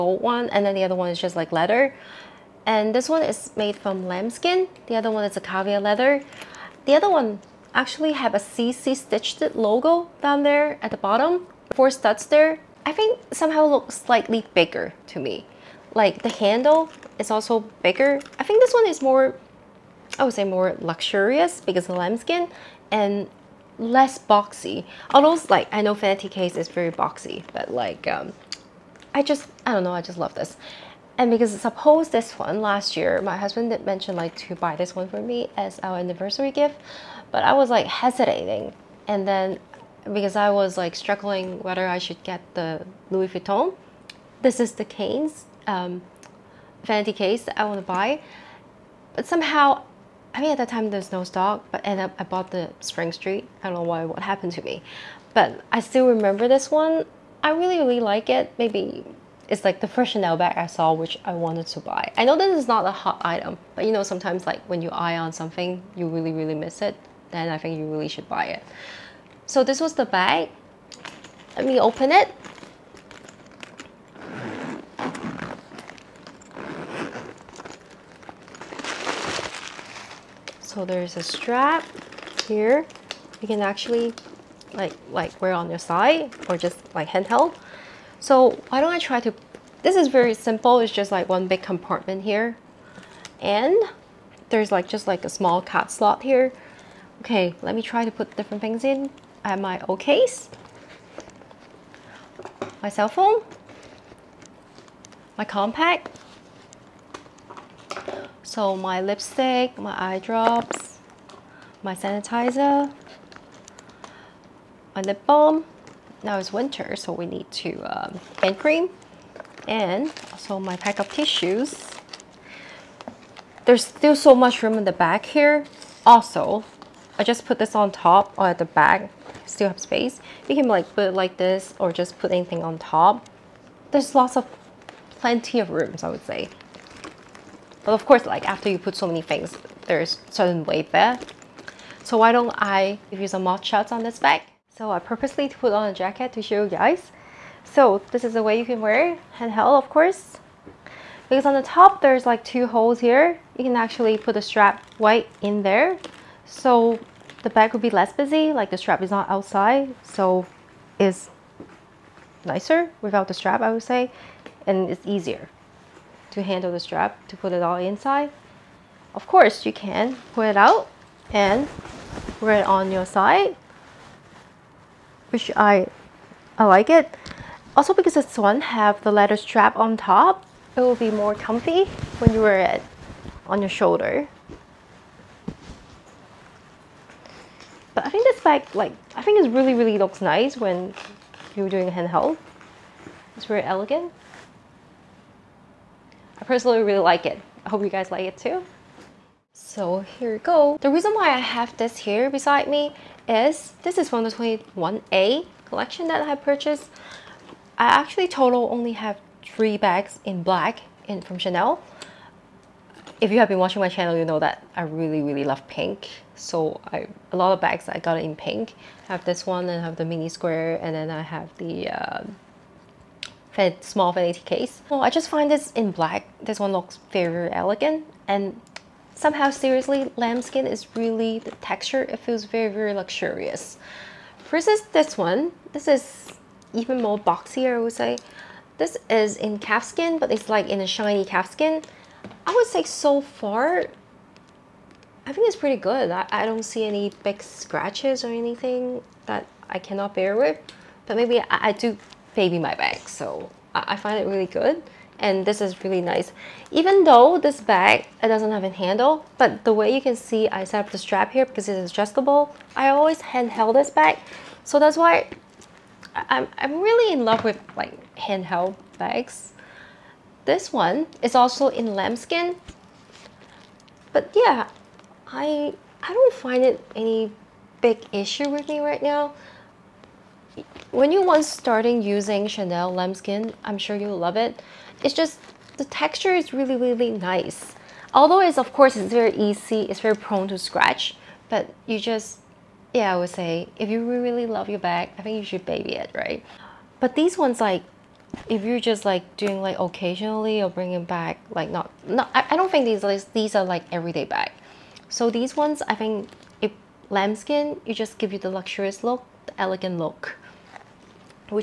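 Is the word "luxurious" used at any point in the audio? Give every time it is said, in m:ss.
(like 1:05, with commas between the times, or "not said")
0:20, 3:52, 5:08.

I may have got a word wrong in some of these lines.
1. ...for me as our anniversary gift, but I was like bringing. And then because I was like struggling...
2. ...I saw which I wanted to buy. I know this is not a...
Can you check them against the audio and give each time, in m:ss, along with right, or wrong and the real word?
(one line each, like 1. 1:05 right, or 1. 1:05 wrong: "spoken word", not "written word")
1. 0:35 wrong: "hesitating", not "bringing"
2. 1:00 right.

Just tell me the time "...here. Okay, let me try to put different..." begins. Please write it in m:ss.
1:36.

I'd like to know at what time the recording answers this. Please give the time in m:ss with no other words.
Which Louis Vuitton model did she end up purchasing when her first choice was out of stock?
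0:52.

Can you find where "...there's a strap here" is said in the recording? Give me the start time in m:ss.
1:20.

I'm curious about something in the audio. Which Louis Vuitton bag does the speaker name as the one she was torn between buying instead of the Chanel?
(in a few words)
Cannes.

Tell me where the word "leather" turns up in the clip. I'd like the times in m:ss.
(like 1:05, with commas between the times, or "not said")
0:01, 0:05, 2:59.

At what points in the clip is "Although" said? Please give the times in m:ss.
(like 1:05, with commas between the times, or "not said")
0:25, 4:48.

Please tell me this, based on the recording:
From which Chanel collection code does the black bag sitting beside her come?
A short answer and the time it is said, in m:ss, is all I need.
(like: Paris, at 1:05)
21A, at 3:24.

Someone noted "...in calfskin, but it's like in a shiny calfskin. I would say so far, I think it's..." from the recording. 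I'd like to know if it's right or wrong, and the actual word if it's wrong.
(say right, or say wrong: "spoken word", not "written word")
right.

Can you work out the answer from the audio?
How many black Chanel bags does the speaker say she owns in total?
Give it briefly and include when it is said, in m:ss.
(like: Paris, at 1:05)
3, at 3:29.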